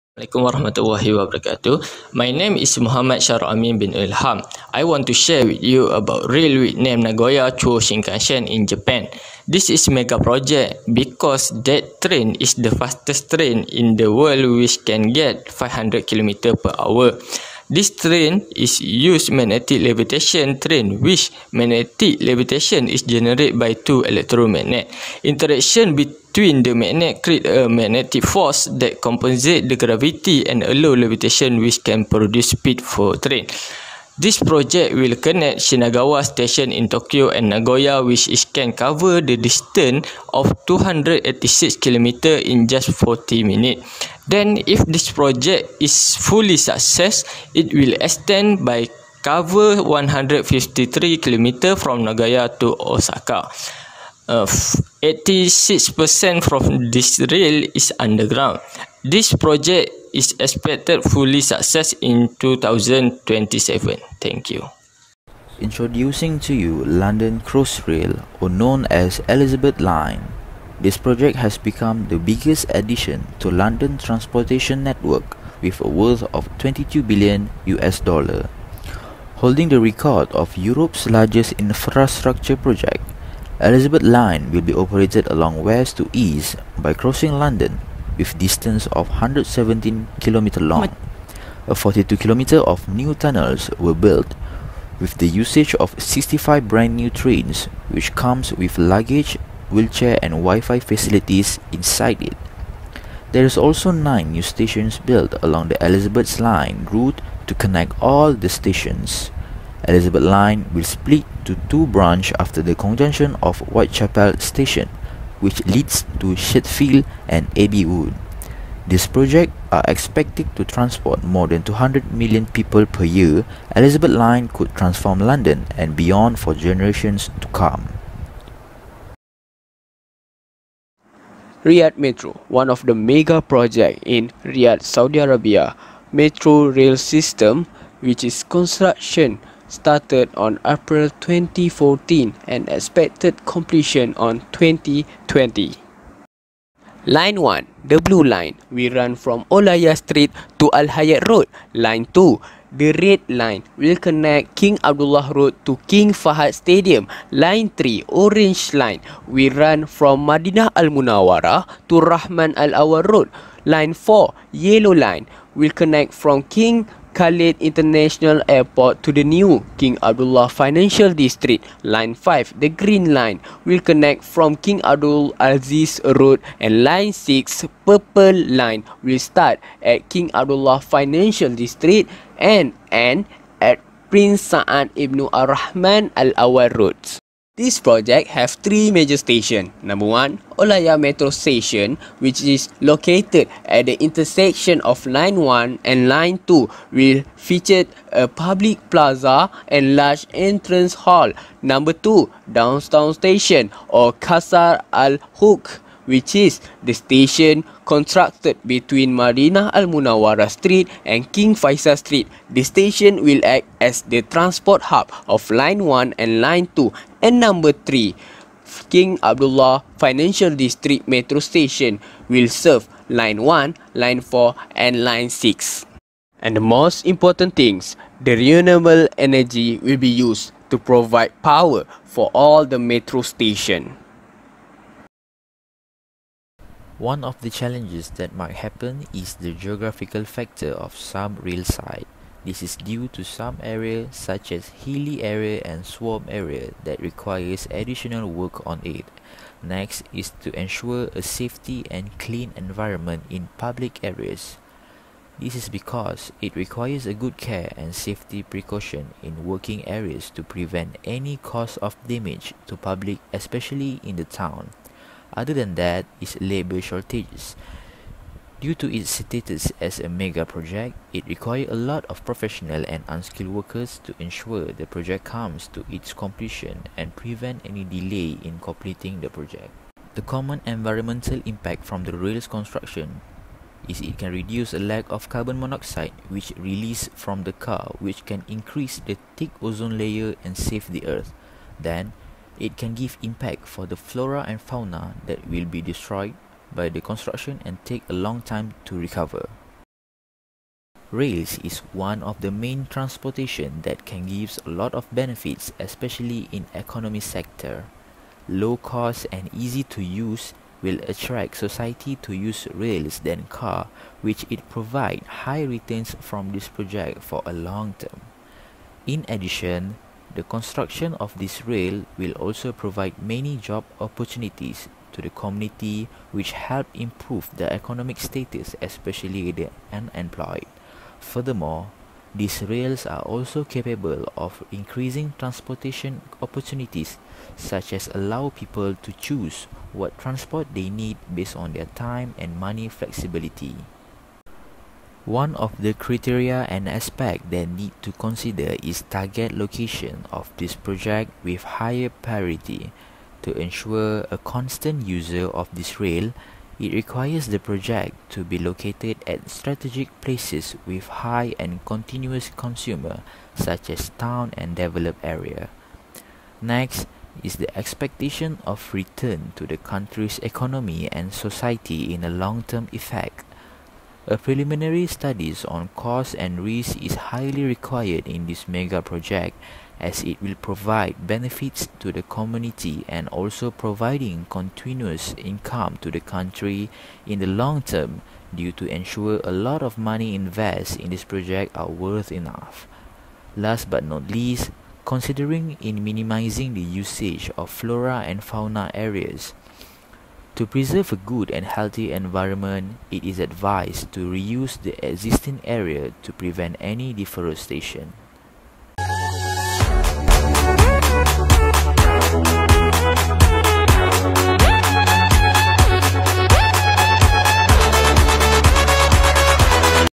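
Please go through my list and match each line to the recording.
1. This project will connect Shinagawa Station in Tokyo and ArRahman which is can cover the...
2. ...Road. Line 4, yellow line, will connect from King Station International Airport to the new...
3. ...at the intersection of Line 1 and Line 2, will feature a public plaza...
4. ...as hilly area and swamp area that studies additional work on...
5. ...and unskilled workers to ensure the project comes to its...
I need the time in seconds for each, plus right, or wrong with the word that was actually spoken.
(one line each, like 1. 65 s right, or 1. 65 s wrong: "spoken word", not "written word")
1. 34 s wrong: "Nagoya", not "ArRahman"
2. 163 s wrong: "Khalid", not "Station"
3. 193 s right
4. 244 s wrong: "requires", not "studies"
5. 272 s right.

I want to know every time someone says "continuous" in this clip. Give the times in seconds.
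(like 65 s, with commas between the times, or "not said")
361 s, 384 s.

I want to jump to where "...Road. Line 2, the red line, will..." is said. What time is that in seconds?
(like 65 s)
151 s.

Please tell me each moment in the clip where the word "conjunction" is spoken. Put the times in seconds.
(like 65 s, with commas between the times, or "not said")
112 s.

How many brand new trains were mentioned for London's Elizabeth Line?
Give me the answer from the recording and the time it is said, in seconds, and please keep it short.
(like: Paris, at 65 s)
65, at 95 s.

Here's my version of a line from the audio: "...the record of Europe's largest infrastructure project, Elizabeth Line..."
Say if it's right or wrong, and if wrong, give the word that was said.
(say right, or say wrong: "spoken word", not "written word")
right.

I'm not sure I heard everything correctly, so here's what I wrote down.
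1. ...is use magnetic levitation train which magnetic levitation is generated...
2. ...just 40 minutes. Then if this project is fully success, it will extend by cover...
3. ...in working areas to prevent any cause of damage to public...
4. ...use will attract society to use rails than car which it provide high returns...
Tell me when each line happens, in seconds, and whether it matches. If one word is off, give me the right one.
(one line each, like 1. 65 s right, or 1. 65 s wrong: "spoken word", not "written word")
1. 18 s right
2. 42 s right
3. 259 s right
4. 310 s right.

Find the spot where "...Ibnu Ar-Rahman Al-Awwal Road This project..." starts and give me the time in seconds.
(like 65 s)
184 s.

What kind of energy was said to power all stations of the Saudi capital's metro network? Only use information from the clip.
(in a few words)
renewable energy.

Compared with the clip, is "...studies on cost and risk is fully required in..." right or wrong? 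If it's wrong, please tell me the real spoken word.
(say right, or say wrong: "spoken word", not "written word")
wrong: "highly", not "fully".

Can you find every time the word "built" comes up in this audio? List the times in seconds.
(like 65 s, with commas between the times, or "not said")
93 s, 104 s.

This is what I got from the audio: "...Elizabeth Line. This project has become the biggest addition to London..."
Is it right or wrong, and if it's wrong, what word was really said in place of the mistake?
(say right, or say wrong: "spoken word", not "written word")
right.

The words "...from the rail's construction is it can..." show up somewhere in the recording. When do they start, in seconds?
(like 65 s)
281 s.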